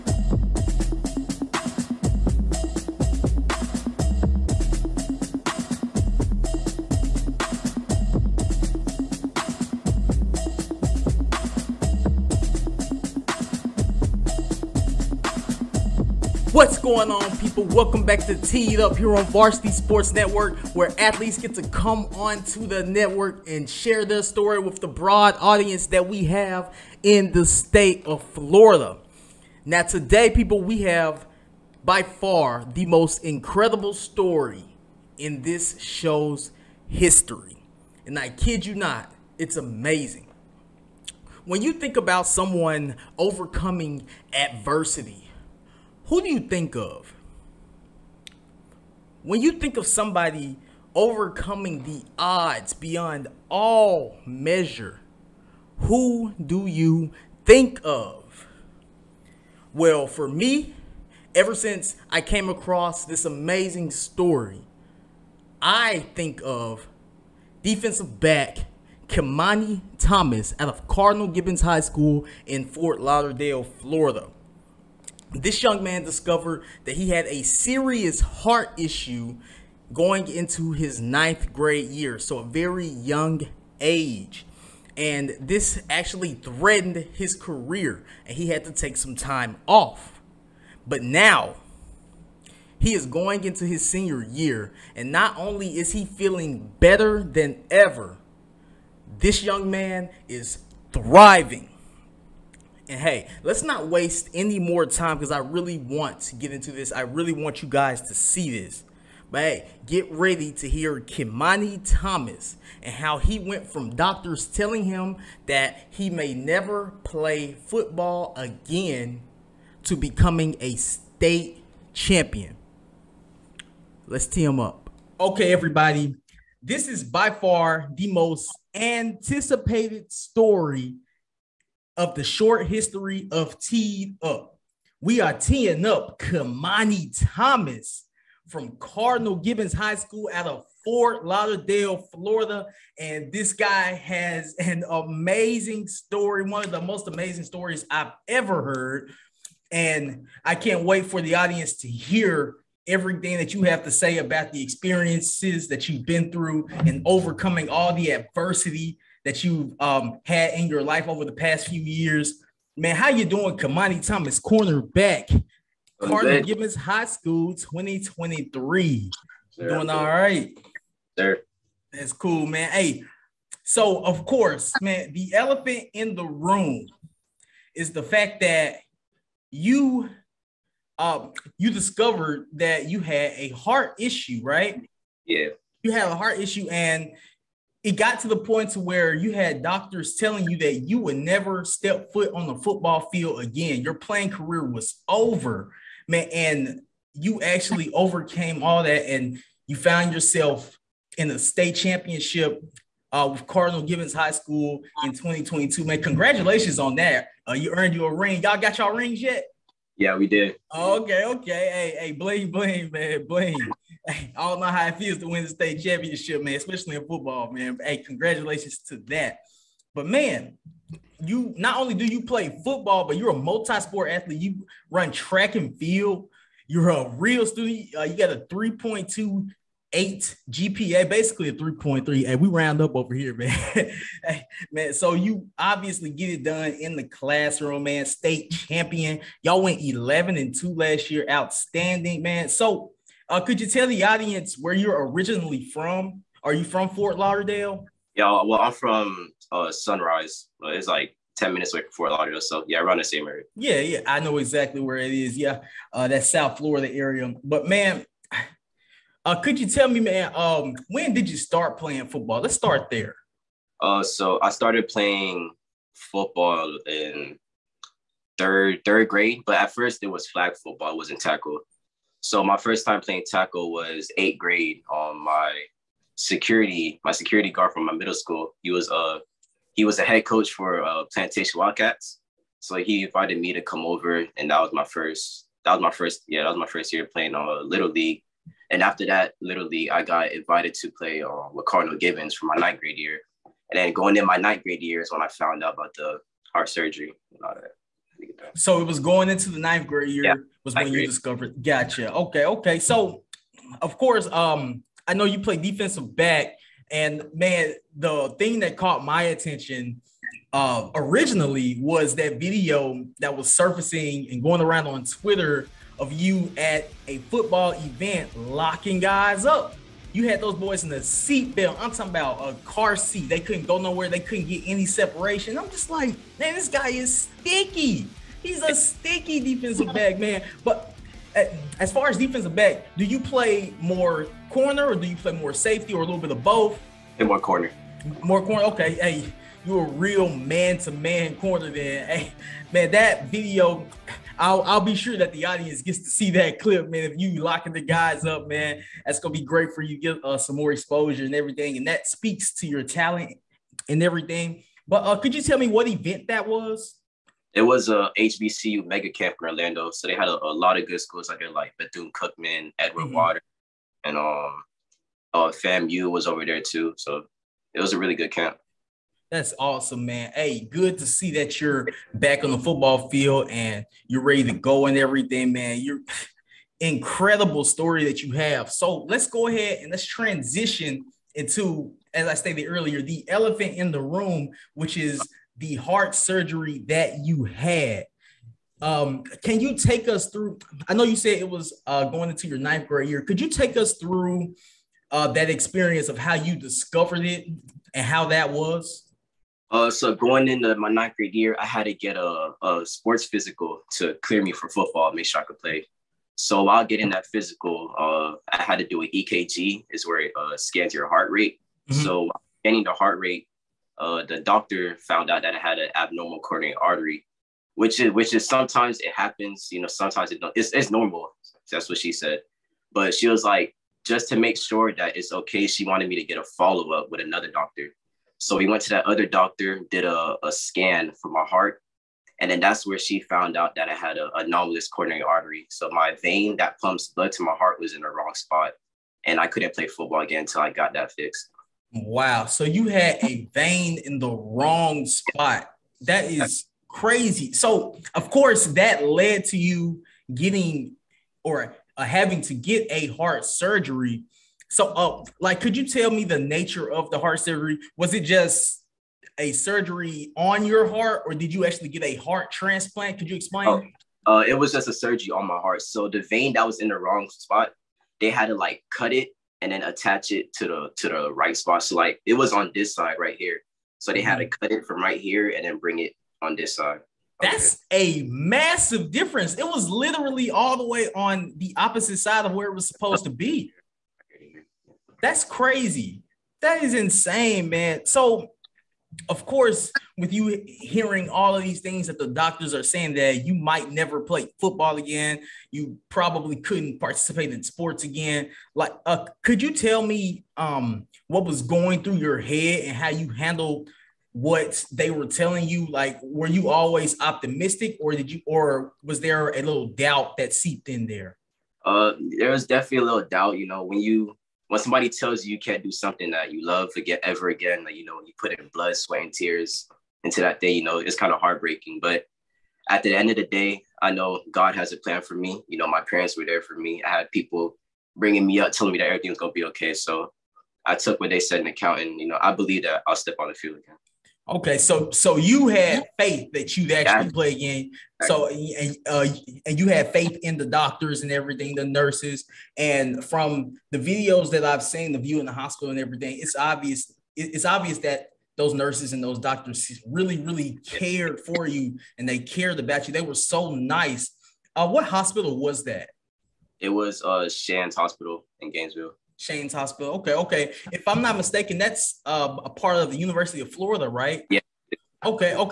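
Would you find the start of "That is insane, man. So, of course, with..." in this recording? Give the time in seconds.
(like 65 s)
486 s.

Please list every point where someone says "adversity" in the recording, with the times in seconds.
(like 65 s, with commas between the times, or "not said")
44 s, 158 s.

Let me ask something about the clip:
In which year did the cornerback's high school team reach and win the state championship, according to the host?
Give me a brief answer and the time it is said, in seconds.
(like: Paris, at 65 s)
2022, at 205 s.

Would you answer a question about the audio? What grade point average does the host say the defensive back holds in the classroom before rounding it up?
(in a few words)
3.28.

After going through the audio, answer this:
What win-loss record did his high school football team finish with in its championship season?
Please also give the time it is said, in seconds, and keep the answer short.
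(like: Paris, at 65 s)
11-2, at 239 s.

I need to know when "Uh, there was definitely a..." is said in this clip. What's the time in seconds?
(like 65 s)
511 s.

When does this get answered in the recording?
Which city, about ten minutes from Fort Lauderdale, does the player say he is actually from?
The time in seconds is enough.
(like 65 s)
249 s.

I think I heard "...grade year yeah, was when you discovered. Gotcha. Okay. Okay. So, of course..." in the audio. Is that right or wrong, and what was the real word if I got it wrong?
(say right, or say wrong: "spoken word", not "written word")
right.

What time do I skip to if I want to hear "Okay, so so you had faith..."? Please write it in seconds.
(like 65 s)
534 s.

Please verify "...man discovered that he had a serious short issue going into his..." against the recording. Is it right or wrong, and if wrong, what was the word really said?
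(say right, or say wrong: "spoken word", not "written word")
wrong: "heart", not "short".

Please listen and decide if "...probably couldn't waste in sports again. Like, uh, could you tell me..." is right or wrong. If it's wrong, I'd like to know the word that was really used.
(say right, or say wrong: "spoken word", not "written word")
wrong: "participate", not "waste".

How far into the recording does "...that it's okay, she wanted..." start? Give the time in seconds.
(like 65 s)
424 s.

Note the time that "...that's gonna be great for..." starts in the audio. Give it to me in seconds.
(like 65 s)
349 s.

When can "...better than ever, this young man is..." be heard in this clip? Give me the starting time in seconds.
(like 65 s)
96 s.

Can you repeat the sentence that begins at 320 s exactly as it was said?
You had those boys in the seatbelt.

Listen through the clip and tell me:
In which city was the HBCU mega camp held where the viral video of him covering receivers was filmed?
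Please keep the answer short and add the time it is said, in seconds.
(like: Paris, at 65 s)
Orlando, at 359 s.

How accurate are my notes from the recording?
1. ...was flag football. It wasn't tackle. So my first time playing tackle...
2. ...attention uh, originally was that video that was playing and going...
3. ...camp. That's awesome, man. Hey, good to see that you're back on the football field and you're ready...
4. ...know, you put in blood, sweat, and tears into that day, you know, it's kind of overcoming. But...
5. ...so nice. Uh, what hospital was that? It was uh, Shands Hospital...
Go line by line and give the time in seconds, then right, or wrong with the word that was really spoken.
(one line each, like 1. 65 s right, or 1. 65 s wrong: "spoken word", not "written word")
1. 270 s right
2. 309 s wrong: "surfacing", not "playing"
3. 368 s right
4. 518 s wrong: "heartbreaking", not "overcoming"
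5. 553 s right.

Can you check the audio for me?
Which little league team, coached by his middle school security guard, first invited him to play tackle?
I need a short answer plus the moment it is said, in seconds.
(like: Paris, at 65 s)
Plantation Wildcats, at 281 s.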